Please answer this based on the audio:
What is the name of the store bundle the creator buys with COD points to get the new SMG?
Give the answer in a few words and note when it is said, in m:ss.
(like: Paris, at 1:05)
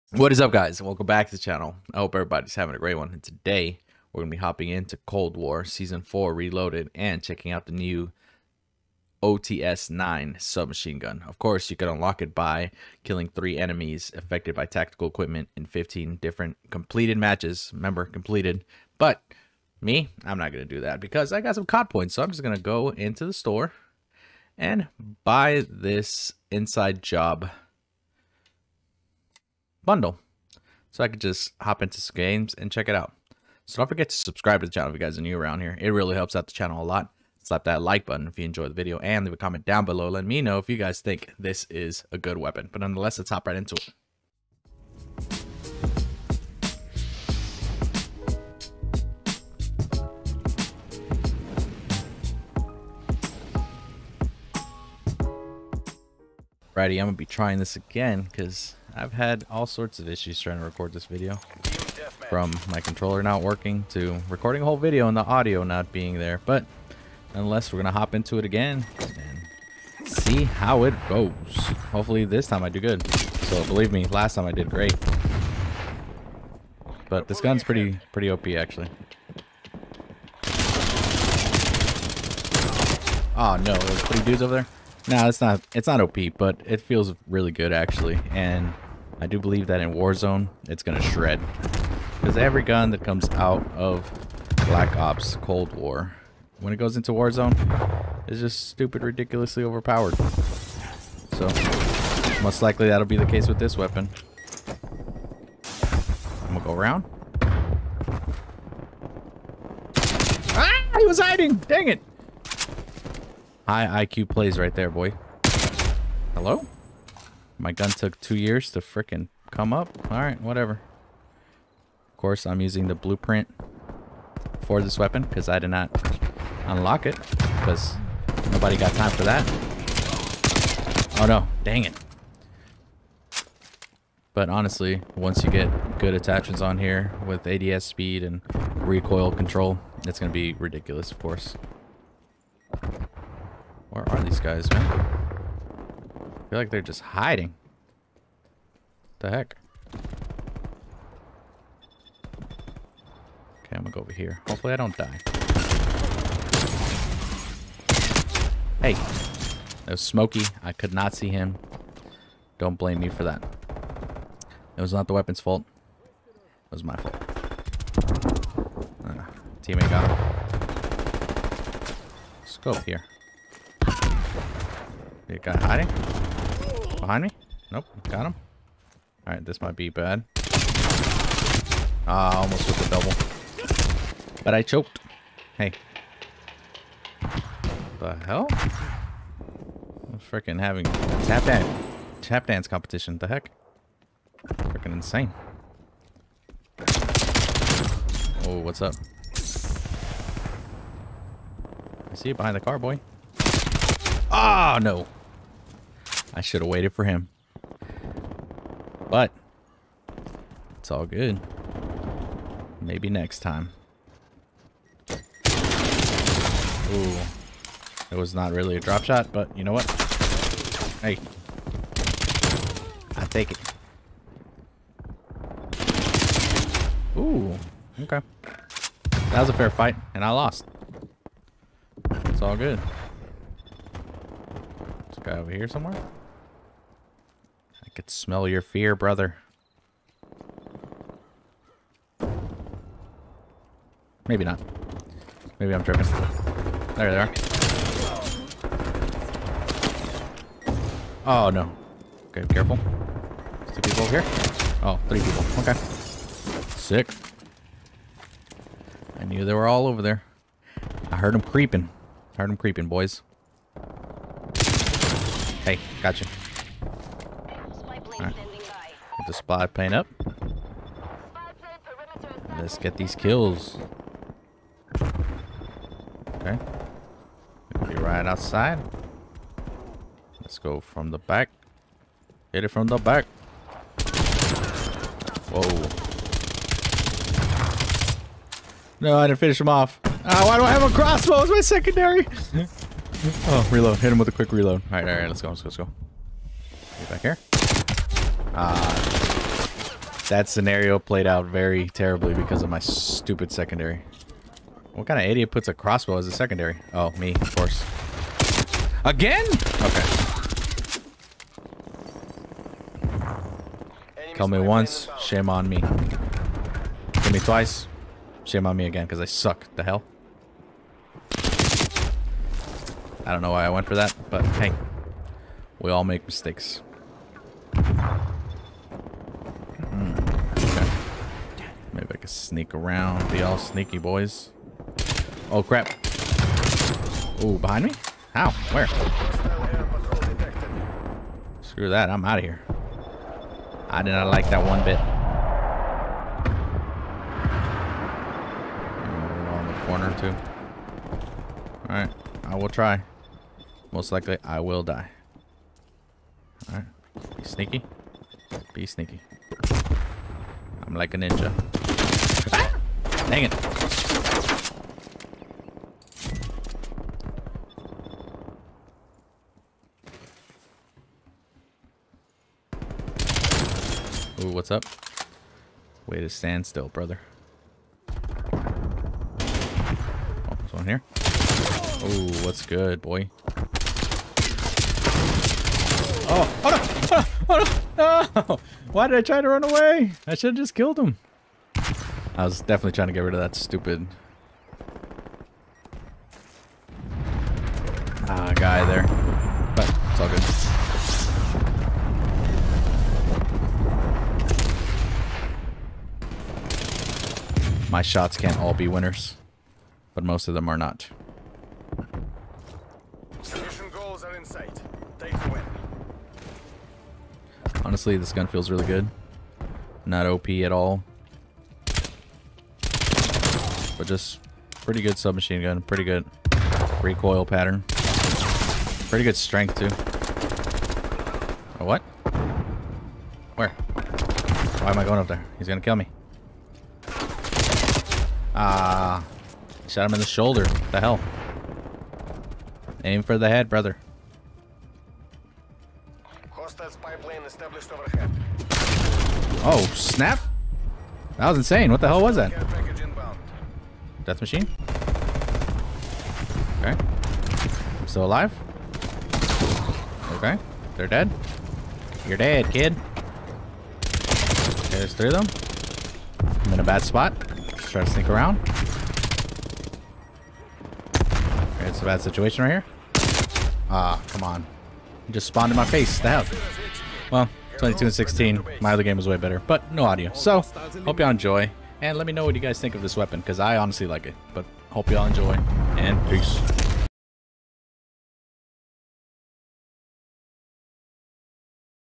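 Inside Job, at 0:26.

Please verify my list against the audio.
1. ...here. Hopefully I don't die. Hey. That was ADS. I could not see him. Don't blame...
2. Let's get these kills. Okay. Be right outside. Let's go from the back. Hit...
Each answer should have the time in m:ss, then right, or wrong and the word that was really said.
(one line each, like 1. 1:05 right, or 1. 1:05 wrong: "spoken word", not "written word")
1. 2:34 wrong: "Smoky", not "ADS"
2. 4:32 right.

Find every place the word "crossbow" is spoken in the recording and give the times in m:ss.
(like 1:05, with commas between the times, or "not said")
4:50, 5:05.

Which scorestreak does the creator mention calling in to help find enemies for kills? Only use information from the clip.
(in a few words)
Spy plane.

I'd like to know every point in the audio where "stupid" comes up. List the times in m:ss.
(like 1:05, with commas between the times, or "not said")
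1:38, 5:02, 6:33.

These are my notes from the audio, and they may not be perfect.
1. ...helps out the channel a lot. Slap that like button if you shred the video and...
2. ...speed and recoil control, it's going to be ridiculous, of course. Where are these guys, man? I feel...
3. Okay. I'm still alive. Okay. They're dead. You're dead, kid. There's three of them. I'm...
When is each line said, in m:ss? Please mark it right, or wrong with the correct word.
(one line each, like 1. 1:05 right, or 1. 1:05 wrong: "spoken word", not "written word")
1. 0:36 wrong: "enjoyed", not "shred"
2. 2:17 right
3. 7:36 right.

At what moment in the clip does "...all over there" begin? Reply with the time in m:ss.
4:19.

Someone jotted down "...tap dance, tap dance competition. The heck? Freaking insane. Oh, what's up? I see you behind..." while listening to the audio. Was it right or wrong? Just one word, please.
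right.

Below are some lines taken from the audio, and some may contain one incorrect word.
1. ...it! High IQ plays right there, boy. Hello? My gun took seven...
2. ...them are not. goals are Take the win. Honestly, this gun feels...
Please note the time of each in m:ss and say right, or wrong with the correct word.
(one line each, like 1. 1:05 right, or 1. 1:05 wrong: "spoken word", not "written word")
1. 1:51 wrong: "two", not "seven"
2. 6:50 right.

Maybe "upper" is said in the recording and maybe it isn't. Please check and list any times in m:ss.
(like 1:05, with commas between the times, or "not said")
not said.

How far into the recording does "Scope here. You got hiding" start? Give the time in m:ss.
2:52.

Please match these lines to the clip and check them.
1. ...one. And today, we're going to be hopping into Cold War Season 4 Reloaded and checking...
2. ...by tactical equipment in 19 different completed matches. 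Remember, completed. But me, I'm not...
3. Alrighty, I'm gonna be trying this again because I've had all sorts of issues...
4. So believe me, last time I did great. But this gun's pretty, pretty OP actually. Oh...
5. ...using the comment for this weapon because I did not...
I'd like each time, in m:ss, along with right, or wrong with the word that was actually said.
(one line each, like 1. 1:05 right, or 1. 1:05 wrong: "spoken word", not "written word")
1. 0:02 right
2. 0:14 wrong: "15", not "19"
3. 0:56 right
4. 1:13 right
5. 2:02 wrong: "blueprint", not "comment".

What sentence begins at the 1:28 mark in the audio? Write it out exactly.
And I do believe that in Warzone, it's gonna shred.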